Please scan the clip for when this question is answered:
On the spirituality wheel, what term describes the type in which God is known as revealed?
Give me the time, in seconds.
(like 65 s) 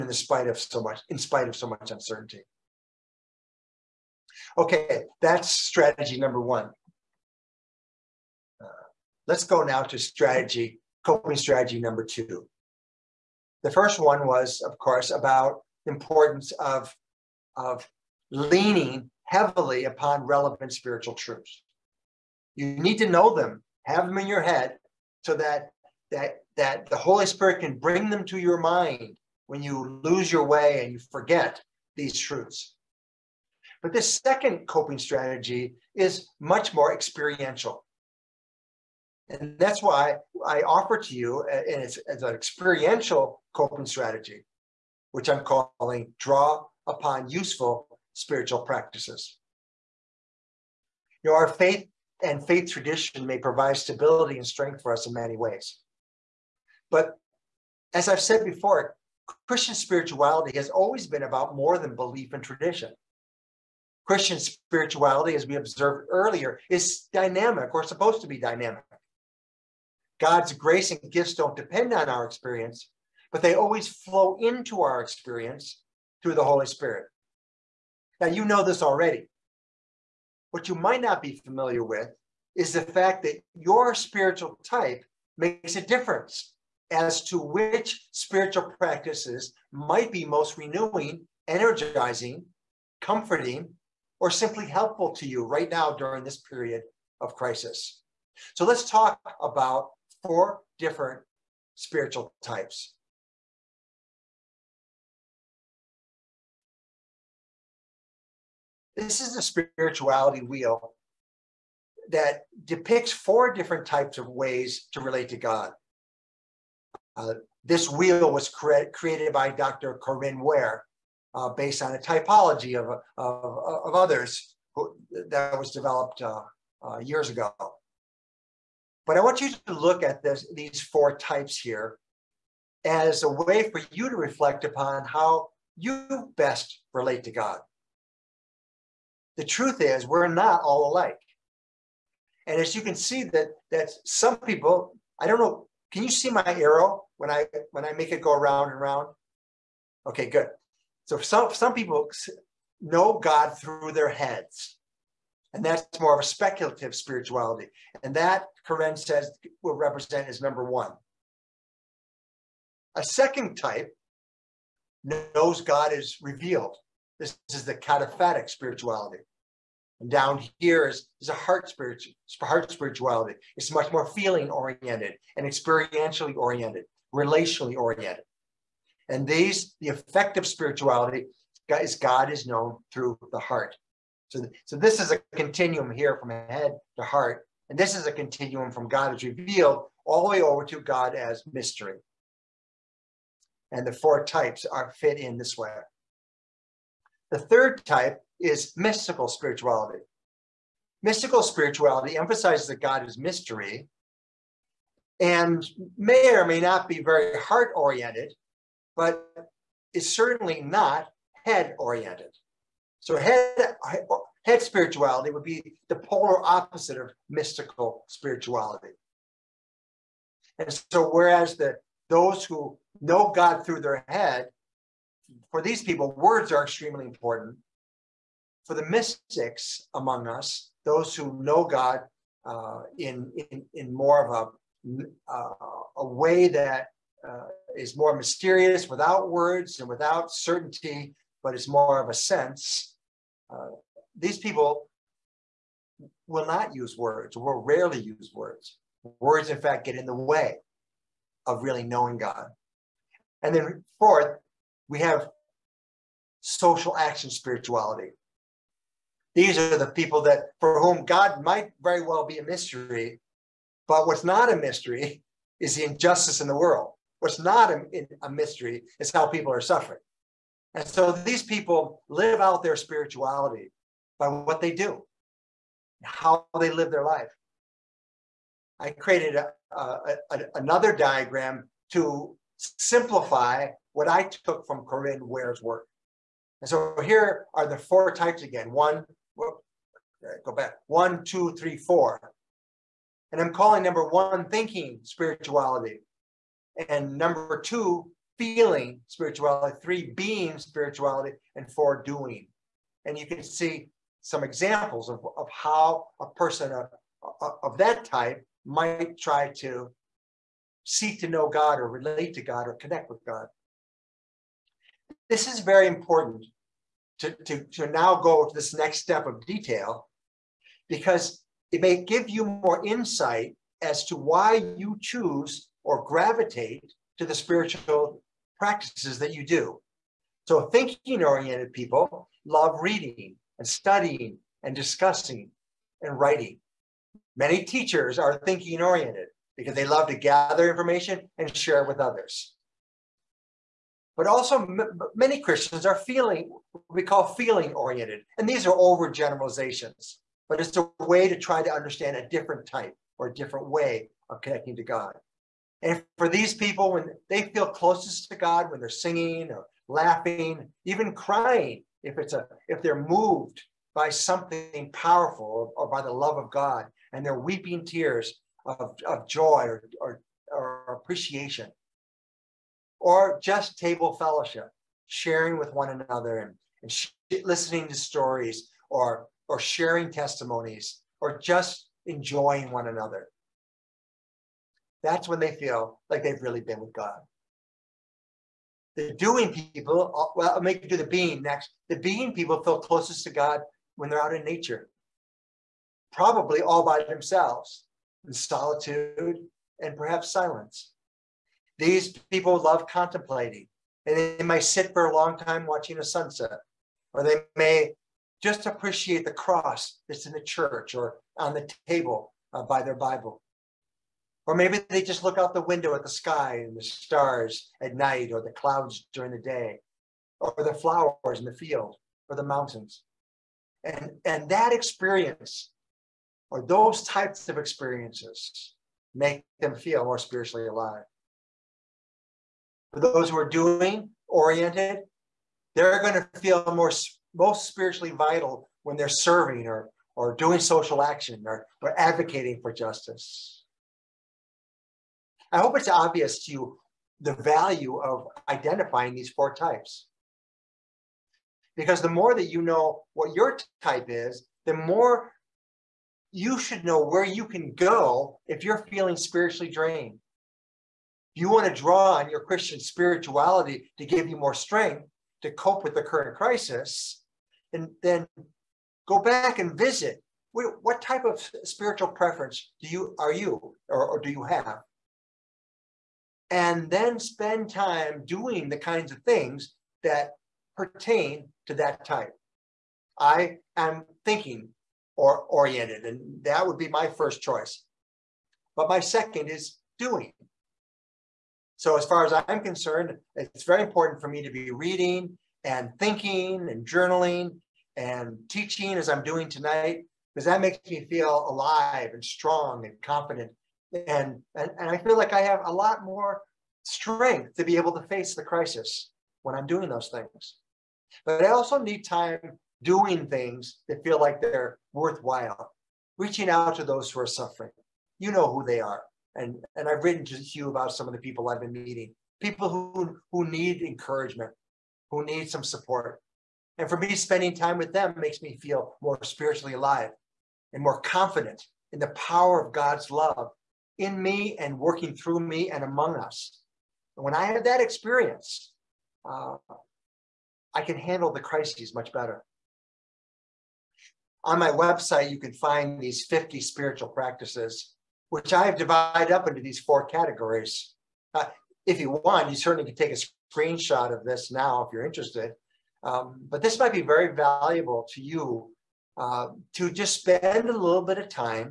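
167 s.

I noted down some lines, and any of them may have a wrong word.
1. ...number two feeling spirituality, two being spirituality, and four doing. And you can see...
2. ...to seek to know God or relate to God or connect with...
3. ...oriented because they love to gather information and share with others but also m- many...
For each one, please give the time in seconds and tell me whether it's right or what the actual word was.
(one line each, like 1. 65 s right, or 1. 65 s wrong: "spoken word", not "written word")
1. 297 s wrong: "three", not "two"
2. 309 s right
3. 338 s right.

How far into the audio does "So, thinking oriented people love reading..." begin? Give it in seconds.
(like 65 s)
330 s.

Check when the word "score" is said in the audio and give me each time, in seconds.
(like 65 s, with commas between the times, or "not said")
not said.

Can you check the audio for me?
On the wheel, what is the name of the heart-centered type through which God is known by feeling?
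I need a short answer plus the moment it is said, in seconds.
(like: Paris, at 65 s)
Affective spirituality, at 179 s.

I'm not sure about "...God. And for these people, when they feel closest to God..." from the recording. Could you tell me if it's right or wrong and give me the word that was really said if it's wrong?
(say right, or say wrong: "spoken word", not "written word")
right.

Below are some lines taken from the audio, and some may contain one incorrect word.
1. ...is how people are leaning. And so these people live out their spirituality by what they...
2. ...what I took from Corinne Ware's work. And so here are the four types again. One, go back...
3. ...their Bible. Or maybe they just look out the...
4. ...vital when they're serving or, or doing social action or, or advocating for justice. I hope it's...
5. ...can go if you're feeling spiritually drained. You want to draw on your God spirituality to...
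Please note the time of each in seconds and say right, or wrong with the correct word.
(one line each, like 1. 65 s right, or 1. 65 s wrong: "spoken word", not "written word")
1. 268 s wrong: "suffering", not "leaning"
2. 283 s right
3. 412 s right
4. 438 s right
5. 457 s wrong: "Christian", not "God".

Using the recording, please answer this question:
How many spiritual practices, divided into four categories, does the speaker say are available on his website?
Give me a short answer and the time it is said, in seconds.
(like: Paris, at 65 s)
50, at 546 s.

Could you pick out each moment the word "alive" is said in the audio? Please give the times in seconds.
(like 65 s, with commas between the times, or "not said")
430 s, 501 s, 529 s.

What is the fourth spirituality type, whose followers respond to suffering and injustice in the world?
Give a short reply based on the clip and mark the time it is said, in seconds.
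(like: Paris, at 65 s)
Social action spirituality, at 256 s.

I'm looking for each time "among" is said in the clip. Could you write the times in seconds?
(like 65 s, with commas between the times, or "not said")
229 s, 535 s.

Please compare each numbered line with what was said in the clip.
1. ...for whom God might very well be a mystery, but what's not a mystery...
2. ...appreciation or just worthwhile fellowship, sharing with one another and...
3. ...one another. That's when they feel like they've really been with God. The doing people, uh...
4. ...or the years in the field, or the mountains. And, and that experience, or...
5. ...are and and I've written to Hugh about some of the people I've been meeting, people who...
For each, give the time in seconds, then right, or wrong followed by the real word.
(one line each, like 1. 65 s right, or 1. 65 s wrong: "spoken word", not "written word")
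1. 260 s right
2. 371 s wrong: "table", not "worthwhile"
3. 382 s right
4. 420 s wrong: "flowers", not "years"
5. 518 s right.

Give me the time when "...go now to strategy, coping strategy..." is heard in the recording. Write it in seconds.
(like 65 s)
9 s.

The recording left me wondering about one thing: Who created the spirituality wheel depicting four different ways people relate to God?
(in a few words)
Dr. Corinne Ware.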